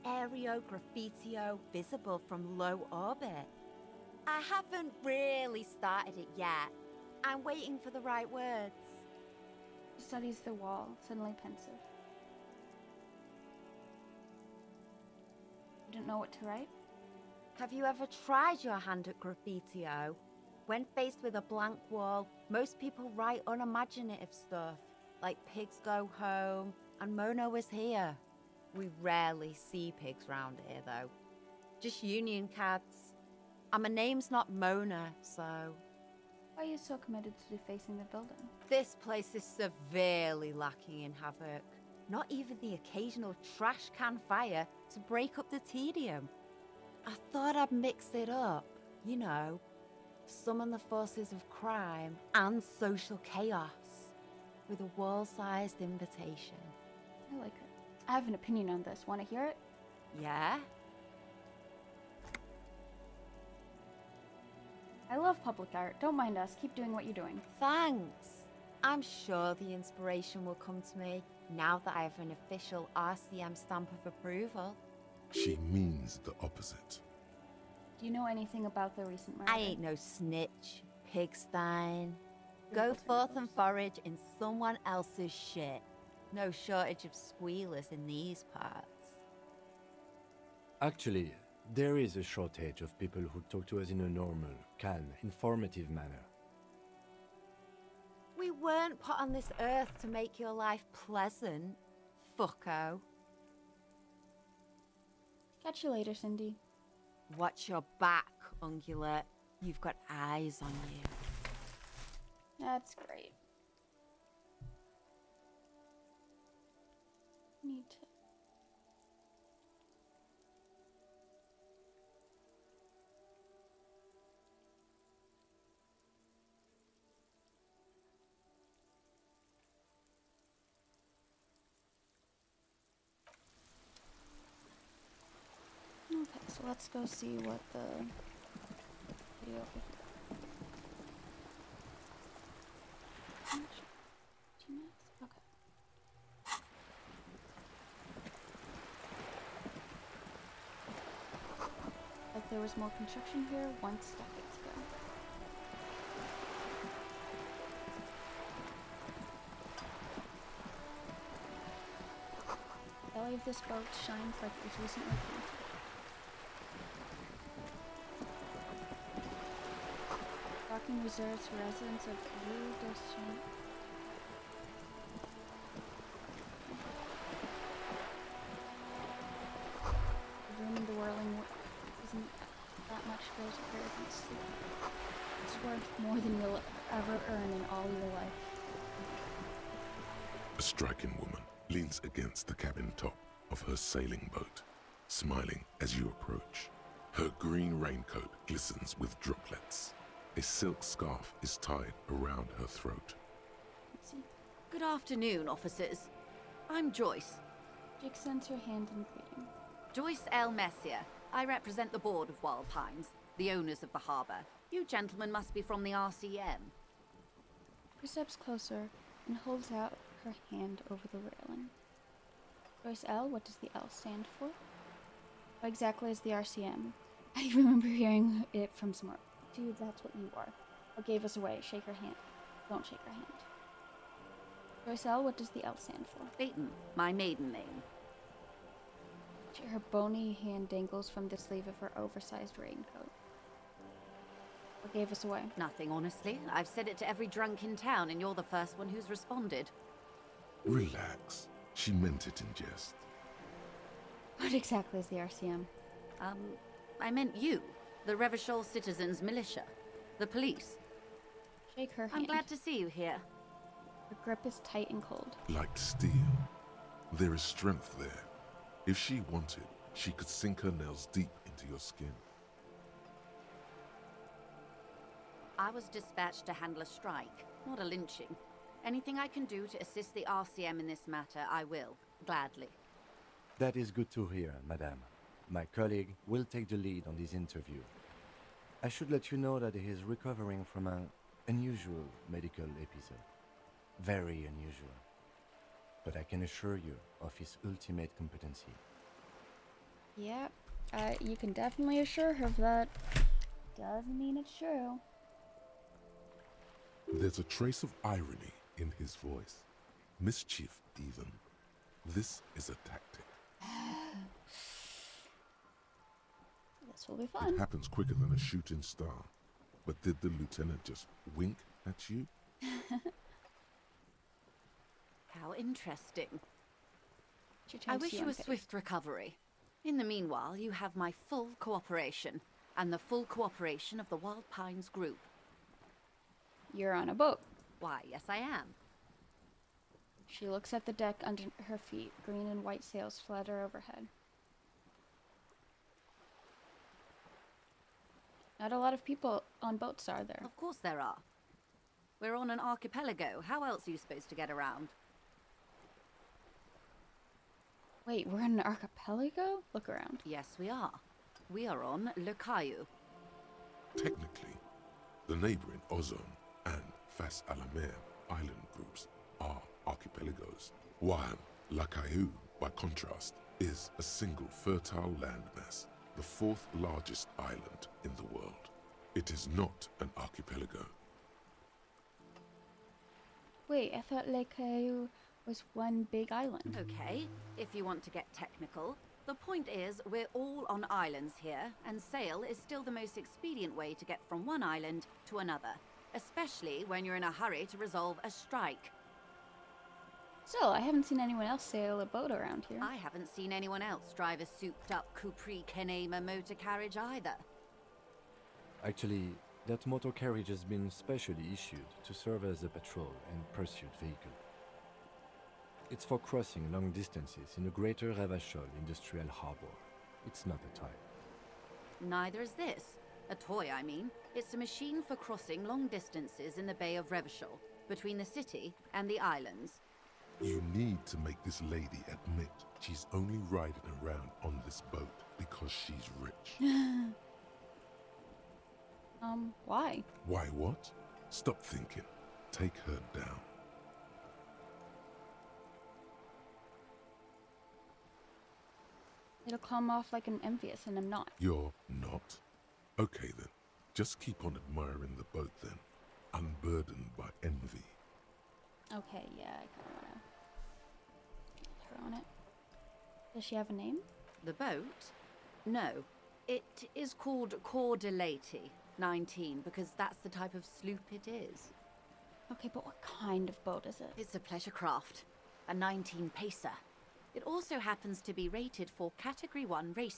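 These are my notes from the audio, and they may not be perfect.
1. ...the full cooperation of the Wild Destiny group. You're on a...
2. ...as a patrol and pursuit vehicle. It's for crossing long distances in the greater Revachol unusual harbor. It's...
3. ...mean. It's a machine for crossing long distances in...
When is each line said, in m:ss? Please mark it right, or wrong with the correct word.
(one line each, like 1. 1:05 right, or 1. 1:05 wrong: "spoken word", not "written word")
1. 5:32 wrong: "Pines", not "Destiny"
2. 6:52 wrong: "industrial", not "unusual"
3. 7:03 right.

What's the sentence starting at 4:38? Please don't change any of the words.
Anything I can do to assist the RCM in this matter, I will, gladly.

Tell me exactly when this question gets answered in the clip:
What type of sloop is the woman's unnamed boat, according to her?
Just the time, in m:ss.
7:47.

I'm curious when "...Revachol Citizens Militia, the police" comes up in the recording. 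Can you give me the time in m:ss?
4:18.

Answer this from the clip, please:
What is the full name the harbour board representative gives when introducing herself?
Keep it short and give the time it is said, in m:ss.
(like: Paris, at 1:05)
Joyce L. Messier, at 3:29.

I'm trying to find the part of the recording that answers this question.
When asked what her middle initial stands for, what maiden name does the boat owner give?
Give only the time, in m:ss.
3:56.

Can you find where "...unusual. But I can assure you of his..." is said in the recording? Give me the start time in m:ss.
4:54.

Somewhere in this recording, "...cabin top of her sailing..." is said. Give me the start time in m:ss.
3:12.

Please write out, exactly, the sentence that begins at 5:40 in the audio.
She looks at the deck under her feet.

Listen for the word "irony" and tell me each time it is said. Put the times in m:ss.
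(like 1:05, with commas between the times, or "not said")
5:08.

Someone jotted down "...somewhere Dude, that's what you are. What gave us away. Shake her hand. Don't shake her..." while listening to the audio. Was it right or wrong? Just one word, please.
right.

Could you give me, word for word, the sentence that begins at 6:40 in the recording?
So I haven't seen anyone else sail a boat around here.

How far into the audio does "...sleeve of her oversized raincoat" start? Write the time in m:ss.
4:01.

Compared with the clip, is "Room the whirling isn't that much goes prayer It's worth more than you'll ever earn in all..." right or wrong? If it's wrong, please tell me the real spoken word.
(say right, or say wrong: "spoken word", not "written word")
right.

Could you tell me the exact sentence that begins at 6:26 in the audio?
Okay, if you want to get technical.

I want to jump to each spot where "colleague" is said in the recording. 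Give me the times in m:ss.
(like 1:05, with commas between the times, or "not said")
4:45.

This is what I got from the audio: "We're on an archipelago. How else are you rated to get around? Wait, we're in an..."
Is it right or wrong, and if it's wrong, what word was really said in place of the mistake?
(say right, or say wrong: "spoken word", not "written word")
wrong: "supposed", not "rated".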